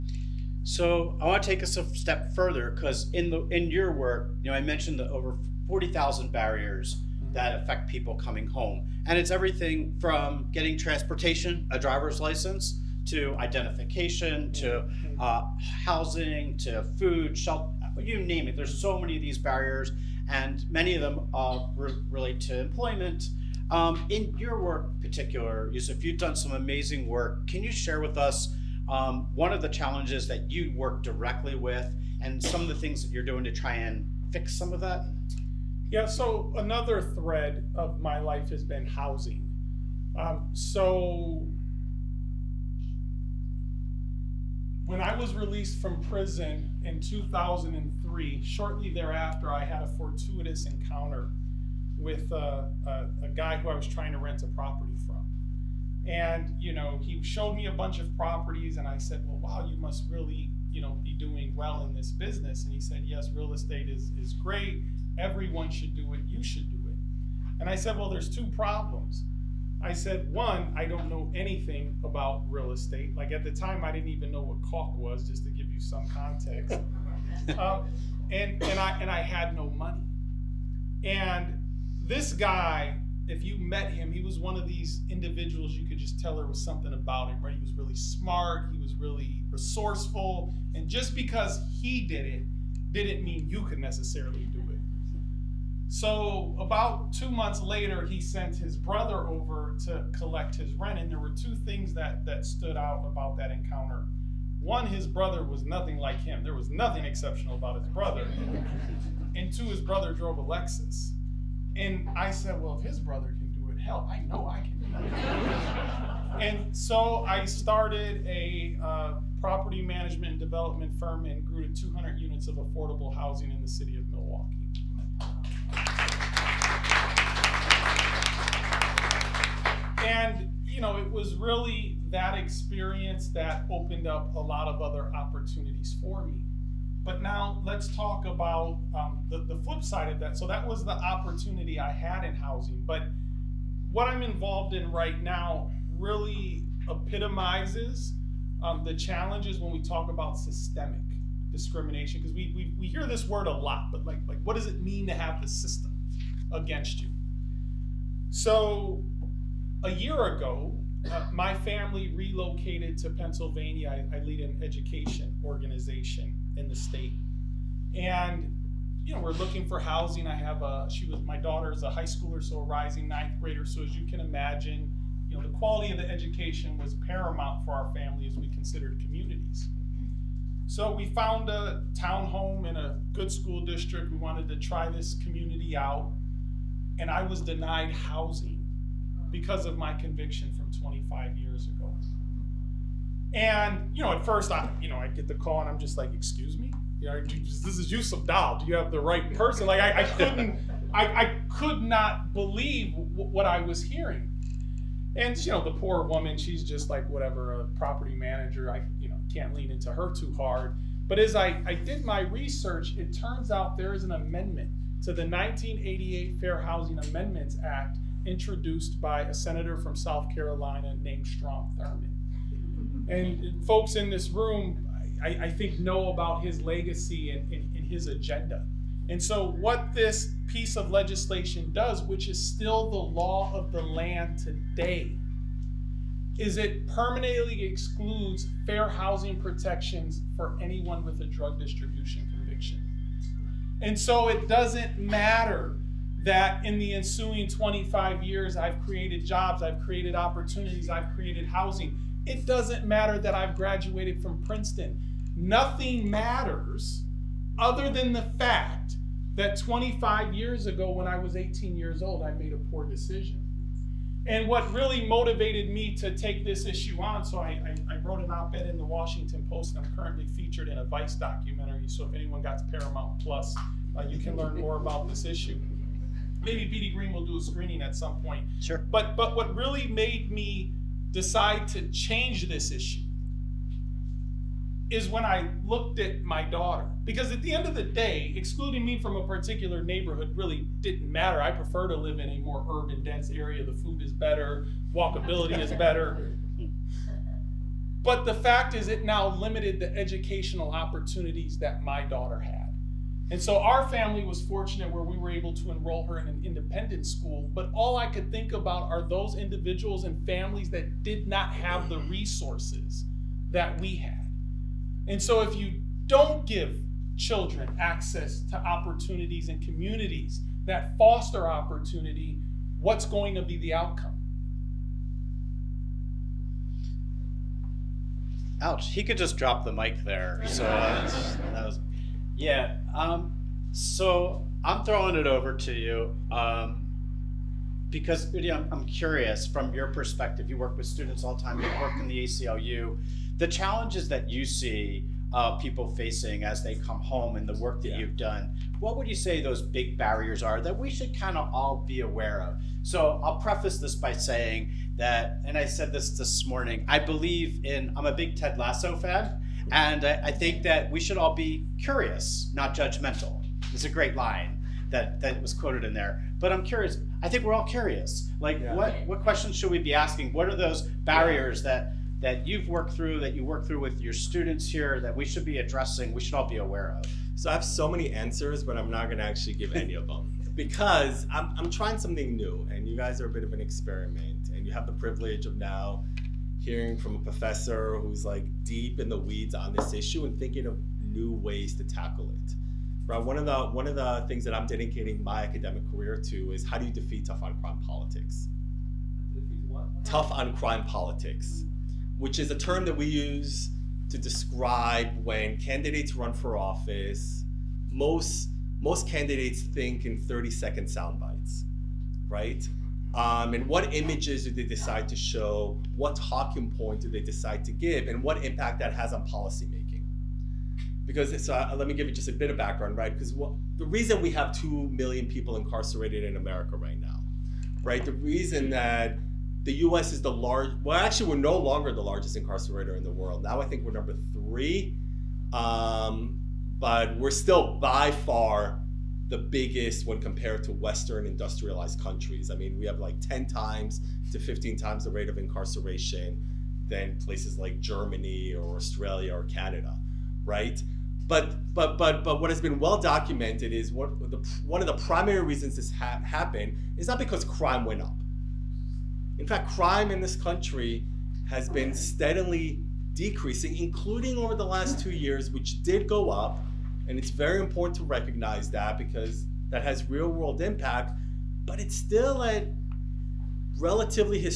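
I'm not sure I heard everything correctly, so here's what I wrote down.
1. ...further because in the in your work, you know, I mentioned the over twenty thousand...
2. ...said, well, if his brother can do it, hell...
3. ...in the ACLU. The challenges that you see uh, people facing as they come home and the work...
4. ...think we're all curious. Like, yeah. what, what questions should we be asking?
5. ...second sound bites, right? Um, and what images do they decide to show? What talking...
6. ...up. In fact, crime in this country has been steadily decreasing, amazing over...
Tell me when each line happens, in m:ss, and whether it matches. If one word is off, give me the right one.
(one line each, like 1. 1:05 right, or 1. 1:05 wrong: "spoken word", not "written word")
1. 0:02 wrong: "forty", not "twenty"
2. 1:52 right
3. 5:41 right
4. 6:07 right
5. 6:50 right
6. 7:38 wrong: "including", not "amazing".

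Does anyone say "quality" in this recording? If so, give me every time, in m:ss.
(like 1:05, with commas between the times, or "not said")
2:55.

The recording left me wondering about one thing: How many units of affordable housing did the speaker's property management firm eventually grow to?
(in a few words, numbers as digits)
200.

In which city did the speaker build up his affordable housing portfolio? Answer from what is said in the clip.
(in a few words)
Milwaukee.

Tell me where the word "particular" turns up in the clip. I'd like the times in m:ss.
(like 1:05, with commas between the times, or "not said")
0:25, 4:49.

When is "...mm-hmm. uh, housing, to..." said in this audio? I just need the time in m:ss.
0:15.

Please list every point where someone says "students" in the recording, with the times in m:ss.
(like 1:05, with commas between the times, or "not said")
5:40, 6:14.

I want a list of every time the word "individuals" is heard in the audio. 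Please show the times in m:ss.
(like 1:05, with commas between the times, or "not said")
1:25, 5:09.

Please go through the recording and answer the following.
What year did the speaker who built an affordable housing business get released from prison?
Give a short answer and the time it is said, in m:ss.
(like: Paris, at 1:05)
2003, at 0:46.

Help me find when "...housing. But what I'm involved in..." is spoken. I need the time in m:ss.
2:22.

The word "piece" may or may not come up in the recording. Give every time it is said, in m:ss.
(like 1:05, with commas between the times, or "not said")
3:50.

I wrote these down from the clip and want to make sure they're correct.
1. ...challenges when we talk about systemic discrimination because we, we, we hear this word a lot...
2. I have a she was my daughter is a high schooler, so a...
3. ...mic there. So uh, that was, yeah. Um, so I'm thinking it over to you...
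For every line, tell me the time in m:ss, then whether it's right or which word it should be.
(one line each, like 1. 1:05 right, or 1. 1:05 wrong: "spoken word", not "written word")
1. 2:28 right
2. 2:50 right
3. 5:29 wrong: "throwing", not "thinking".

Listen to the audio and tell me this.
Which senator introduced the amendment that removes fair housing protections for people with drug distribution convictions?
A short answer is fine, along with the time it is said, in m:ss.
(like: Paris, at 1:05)
Strom Thurmond, at 3:41.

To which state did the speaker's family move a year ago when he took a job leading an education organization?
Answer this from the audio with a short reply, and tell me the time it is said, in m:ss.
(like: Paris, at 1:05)
Pennsylvania, at 2:43.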